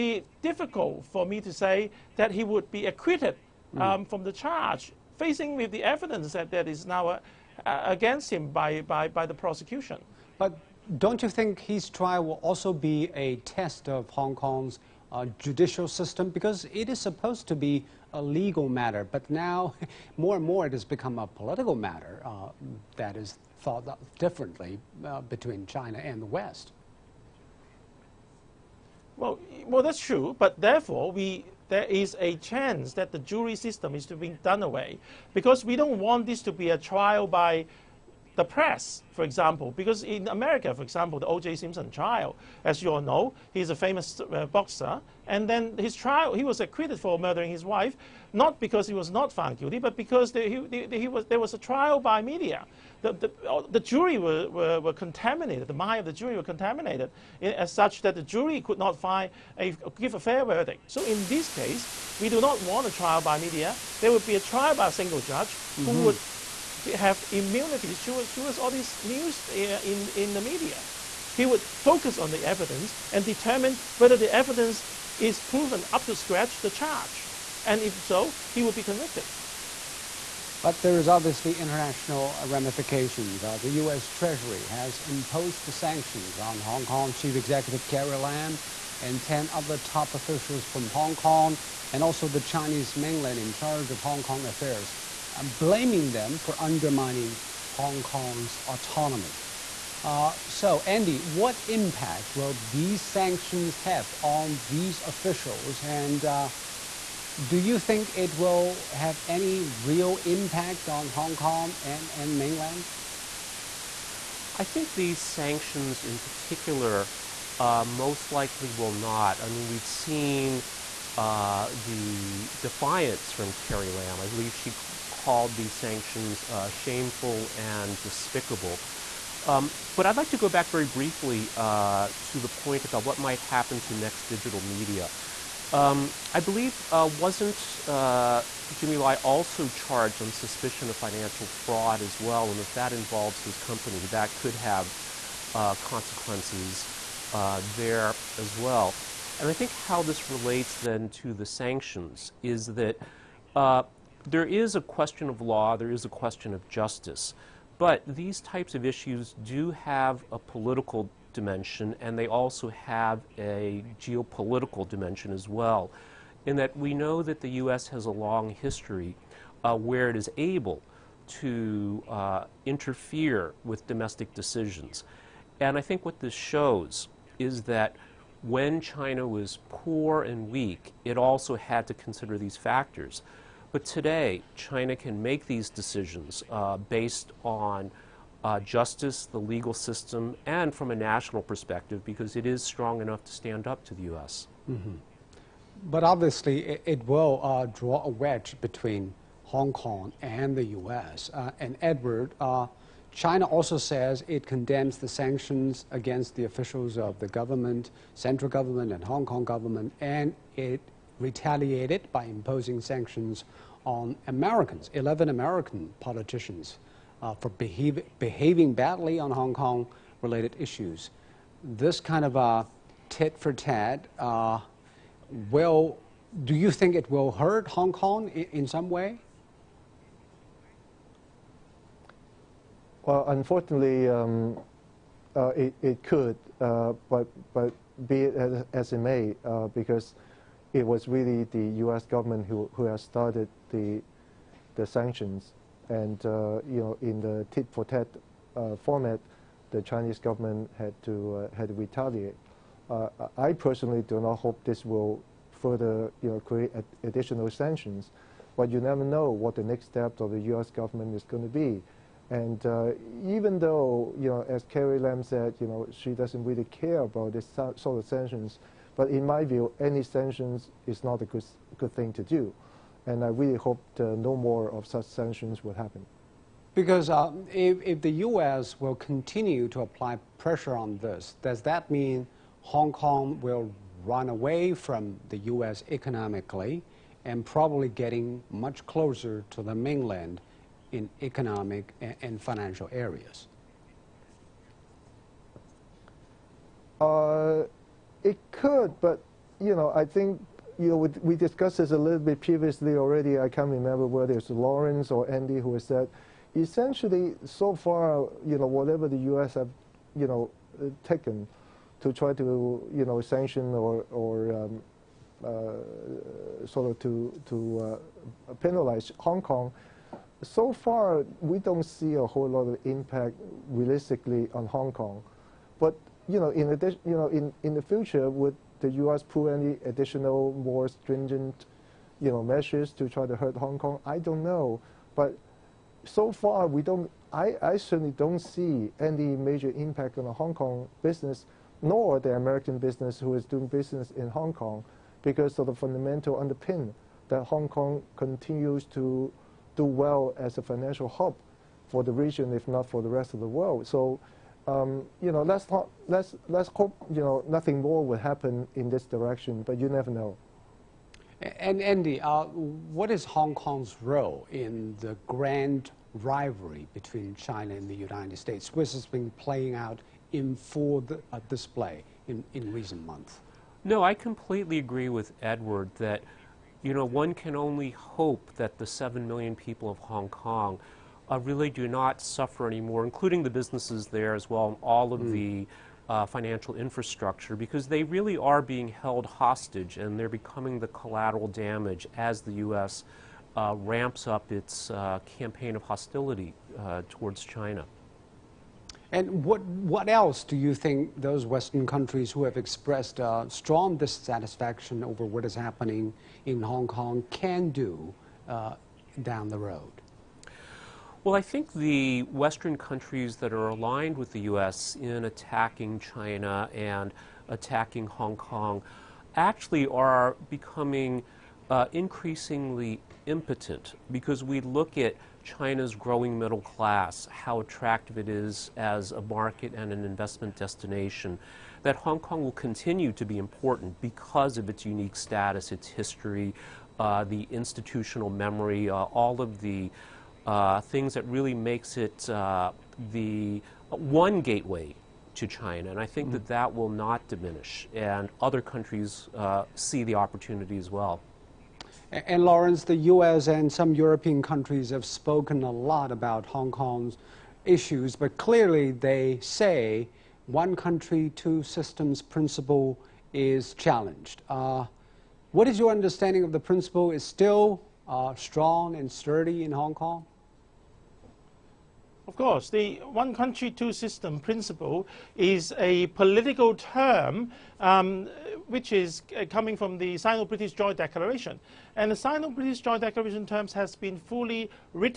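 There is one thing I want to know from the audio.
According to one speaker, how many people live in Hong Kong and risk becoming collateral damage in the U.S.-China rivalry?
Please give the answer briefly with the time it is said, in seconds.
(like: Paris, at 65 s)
7 million, at 378 s.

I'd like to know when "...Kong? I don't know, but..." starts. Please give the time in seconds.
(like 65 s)
333 s.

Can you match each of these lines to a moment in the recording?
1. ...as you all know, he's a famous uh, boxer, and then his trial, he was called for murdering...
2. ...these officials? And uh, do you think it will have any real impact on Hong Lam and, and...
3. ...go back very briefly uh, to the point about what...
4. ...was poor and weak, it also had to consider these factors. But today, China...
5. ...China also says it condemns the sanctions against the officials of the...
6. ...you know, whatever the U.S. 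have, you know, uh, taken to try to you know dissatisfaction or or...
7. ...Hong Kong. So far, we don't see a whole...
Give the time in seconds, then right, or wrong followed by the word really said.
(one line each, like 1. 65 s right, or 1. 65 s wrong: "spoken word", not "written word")
1. 42 s wrong: "acquitted", not "called"
2. 104 s wrong: "Kong", not "Lam"
3. 130 s right
4. 179 s right
5. 203 s right
6. 308 s wrong: "sanction", not "dissatisfaction"
7. 319 s right.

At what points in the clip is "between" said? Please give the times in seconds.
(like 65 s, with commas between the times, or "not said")
25 s, 198 s, 366 s.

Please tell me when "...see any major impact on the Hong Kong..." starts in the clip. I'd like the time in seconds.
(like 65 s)
338 s.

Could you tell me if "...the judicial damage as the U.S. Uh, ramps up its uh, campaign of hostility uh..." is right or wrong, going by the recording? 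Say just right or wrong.
wrong.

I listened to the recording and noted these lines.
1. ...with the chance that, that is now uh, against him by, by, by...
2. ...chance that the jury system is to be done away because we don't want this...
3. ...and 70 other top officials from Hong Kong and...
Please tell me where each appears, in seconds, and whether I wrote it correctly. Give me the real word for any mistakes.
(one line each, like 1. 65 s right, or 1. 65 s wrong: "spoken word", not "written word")
1. 5 s wrong: "evidence", not "chance"
2. 32 s right
3. 89 s wrong: "10", not "70".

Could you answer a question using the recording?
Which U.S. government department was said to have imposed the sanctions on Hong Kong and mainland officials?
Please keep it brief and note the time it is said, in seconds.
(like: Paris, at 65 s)
U.S. Treasury, at 83 s.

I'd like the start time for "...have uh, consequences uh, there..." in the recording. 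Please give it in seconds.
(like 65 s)
144 s.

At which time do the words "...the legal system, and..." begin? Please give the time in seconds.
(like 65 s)
189 s.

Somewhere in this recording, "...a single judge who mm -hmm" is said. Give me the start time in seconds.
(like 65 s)
64 s.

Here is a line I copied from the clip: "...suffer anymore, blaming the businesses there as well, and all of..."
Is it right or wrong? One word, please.
wrong.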